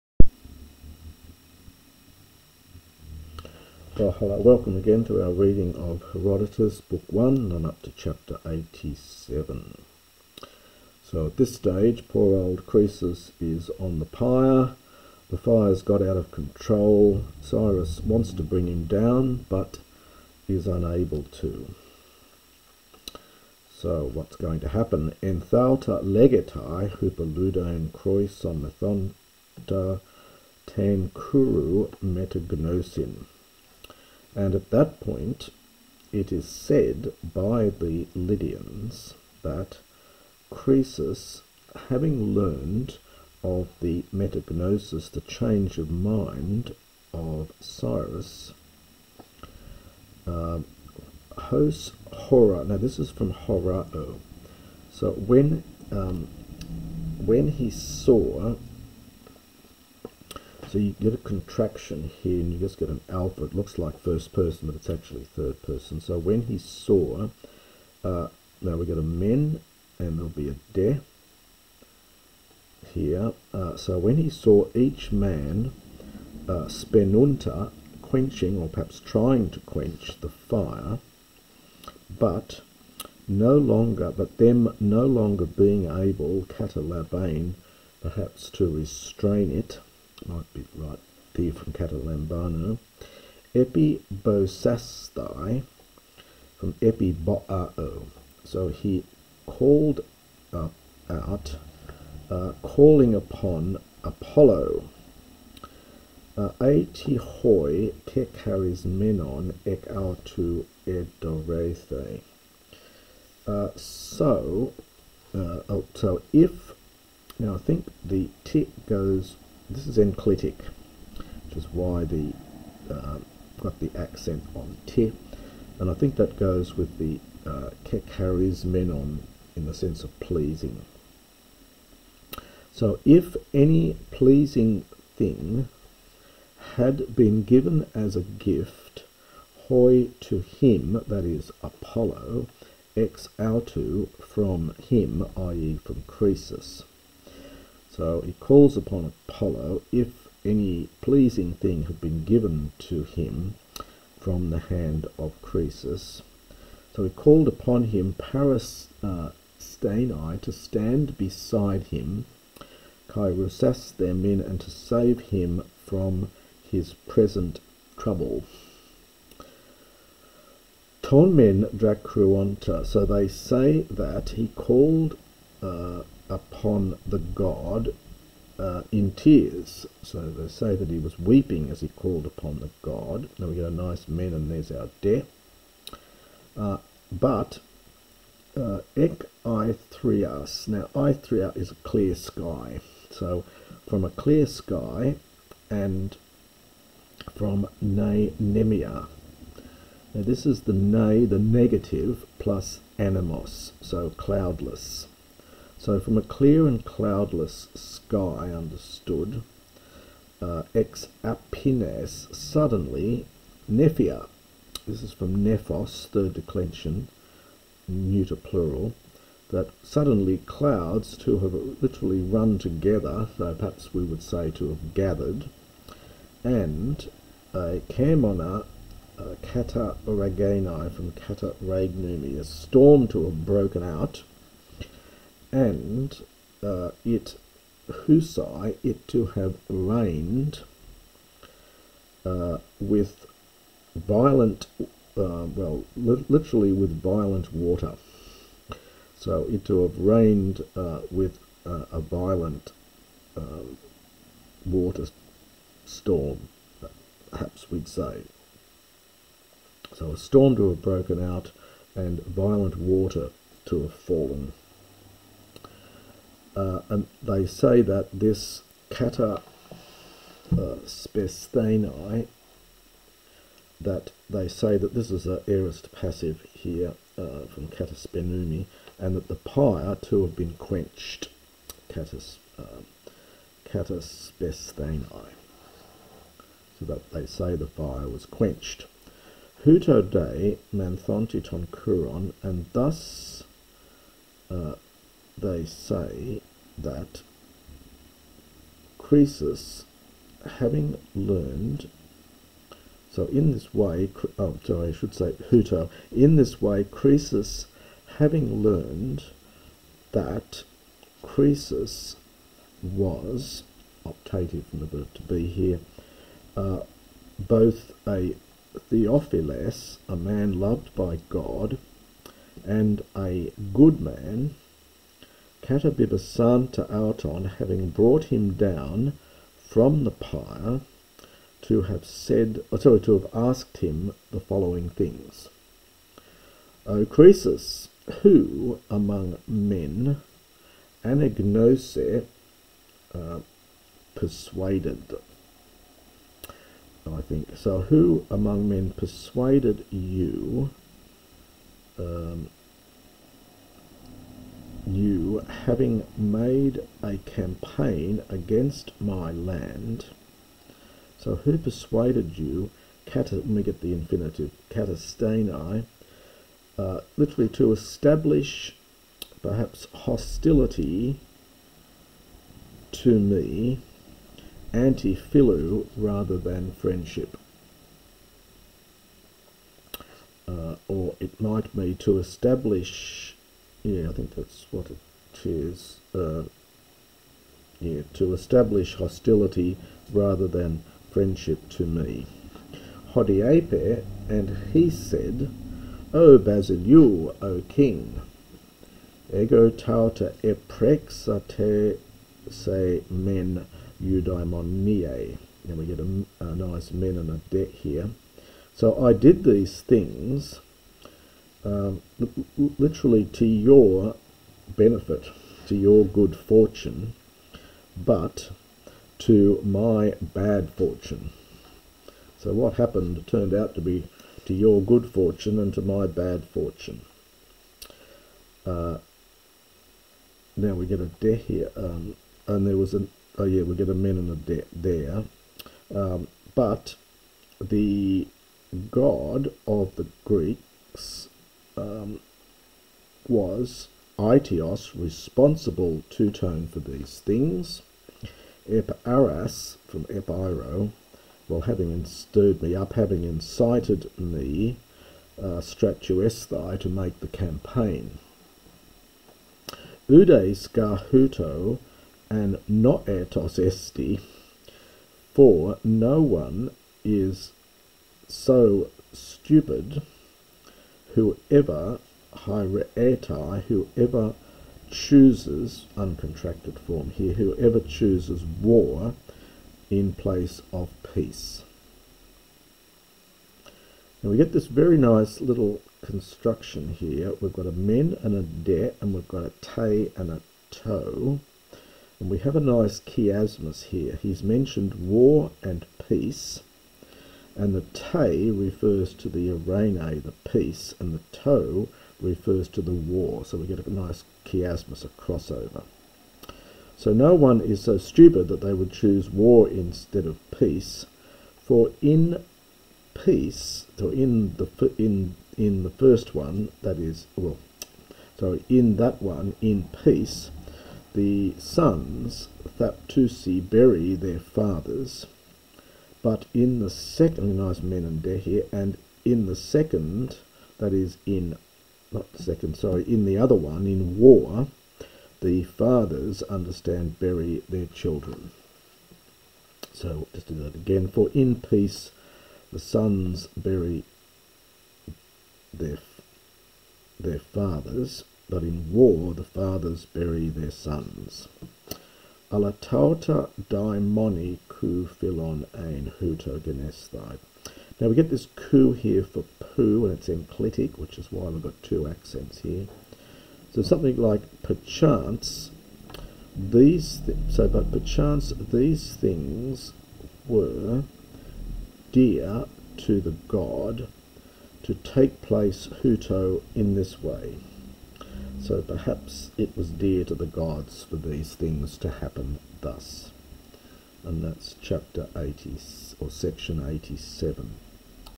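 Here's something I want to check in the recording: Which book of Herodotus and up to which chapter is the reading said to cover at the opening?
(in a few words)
Book 1, chapter 87.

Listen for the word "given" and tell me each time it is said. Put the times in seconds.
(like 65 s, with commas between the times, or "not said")
137 s, 152 s.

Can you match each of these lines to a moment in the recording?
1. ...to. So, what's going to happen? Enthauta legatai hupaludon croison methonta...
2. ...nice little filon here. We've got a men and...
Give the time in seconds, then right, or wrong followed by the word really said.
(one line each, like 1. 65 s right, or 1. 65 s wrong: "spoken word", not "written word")
1. 21 s right
2. 484 s wrong: "construction", not "filon".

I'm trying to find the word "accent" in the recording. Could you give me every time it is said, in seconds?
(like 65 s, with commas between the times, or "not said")
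123 s, 562 s.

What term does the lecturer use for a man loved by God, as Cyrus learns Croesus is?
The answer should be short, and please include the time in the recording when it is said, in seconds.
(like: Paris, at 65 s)
Theophilus, at 318 s.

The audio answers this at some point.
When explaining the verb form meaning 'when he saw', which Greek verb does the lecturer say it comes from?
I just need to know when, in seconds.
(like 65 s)
53 s.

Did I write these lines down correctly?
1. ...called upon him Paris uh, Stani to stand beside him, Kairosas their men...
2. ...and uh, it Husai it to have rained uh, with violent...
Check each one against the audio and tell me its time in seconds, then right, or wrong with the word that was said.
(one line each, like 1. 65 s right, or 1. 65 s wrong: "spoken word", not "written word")
1. 157 s right
2. 235 s right.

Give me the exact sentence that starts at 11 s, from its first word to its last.
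So, at this stage, poor old Croesus is on the pyre.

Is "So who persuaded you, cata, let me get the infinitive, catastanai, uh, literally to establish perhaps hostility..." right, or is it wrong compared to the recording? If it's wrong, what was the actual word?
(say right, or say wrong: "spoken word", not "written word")
right.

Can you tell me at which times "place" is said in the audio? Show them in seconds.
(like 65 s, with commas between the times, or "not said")
480 s, 575 s.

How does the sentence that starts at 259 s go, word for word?
So a storm to have broken out and violent water to have fallen.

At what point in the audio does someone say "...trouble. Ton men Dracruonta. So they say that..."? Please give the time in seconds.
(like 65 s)
167 s.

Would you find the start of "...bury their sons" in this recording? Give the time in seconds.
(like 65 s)
550 s.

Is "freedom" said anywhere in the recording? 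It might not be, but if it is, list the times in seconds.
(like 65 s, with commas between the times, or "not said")
not said.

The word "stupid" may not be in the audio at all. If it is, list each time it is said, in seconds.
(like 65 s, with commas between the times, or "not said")
469 s, 507 s.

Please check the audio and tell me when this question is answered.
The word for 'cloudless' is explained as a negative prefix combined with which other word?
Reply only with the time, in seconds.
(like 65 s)
202 s.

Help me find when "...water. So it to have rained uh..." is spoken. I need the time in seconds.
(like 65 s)
247 s.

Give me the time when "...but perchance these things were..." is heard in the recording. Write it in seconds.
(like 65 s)
567 s.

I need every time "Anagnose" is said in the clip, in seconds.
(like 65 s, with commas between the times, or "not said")
341 s.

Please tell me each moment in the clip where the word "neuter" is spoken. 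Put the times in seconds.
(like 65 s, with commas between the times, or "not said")
217 s.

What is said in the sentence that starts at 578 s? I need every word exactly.
So perhaps it was dear to the gods for these things to happen thus and that's chapter 80 or section 87.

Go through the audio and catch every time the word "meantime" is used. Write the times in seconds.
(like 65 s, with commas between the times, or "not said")
not said.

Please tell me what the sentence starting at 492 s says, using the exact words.
And we have a nice chiasmus here.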